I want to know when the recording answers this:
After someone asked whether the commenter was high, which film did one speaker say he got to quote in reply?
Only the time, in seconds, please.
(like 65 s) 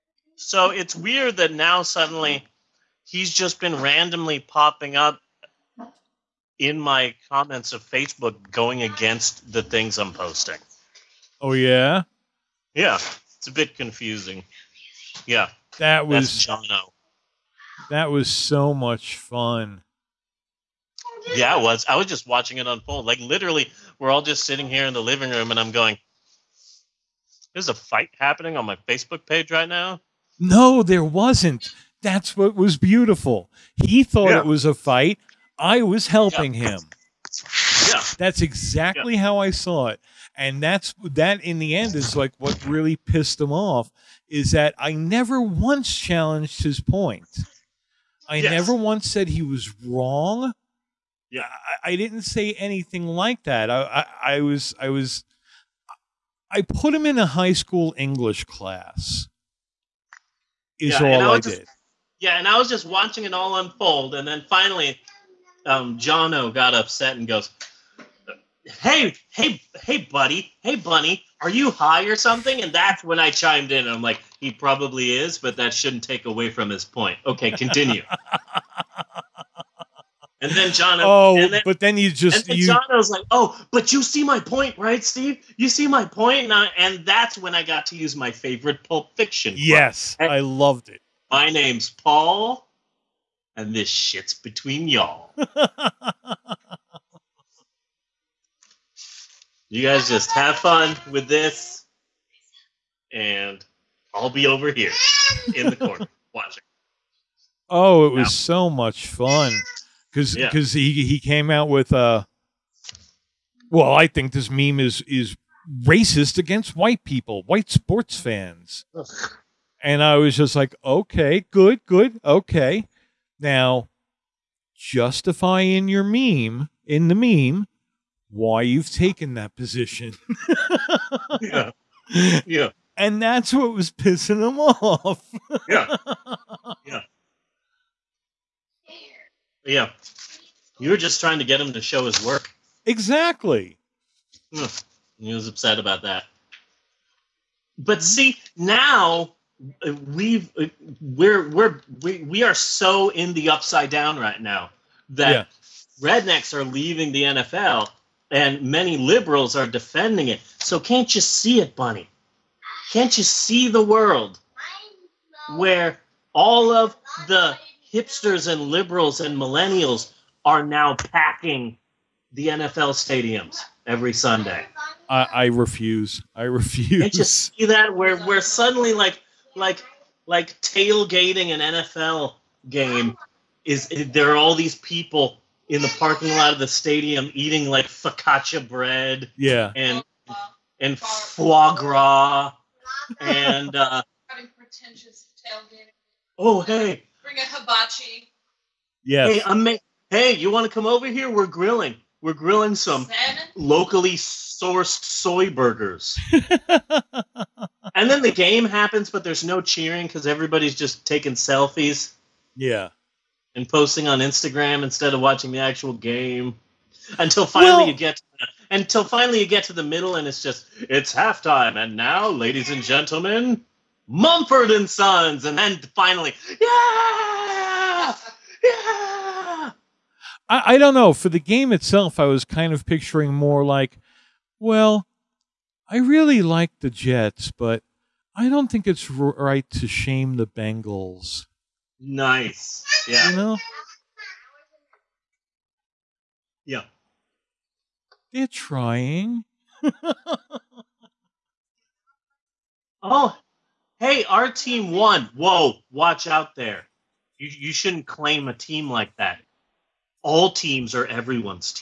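88 s.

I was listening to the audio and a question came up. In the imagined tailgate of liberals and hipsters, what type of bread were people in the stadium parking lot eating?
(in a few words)
focaccia.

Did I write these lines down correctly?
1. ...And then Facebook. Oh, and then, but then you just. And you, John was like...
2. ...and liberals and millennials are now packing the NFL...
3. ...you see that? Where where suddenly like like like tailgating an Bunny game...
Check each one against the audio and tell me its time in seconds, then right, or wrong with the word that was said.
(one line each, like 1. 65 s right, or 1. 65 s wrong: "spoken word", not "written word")
1. 80 s wrong: "John", not "Facebook"
2. 168 s right
3. 177 s wrong: "NFL", not "Bunny".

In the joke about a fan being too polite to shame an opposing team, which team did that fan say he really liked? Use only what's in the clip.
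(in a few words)
the Jets.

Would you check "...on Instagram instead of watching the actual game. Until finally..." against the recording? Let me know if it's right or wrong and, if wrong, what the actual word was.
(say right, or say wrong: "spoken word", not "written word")
right.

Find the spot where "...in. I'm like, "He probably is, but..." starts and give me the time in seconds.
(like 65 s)
73 s.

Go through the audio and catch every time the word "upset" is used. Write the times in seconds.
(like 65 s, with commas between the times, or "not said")
66 s, 145 s.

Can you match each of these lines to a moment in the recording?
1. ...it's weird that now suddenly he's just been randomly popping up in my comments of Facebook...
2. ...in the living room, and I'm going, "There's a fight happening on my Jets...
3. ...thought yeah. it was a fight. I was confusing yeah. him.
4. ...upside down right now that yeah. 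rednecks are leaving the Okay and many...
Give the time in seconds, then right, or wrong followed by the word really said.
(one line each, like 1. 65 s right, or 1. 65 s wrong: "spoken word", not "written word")
1. 0 s right
2. 24 s wrong: "Facebook", not "Jets"
3. 34 s wrong: "helping", not "confusing"
4. 153 s wrong: "NFL", not "Okay".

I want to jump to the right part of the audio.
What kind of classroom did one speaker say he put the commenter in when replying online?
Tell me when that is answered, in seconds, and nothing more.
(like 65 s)
57 s.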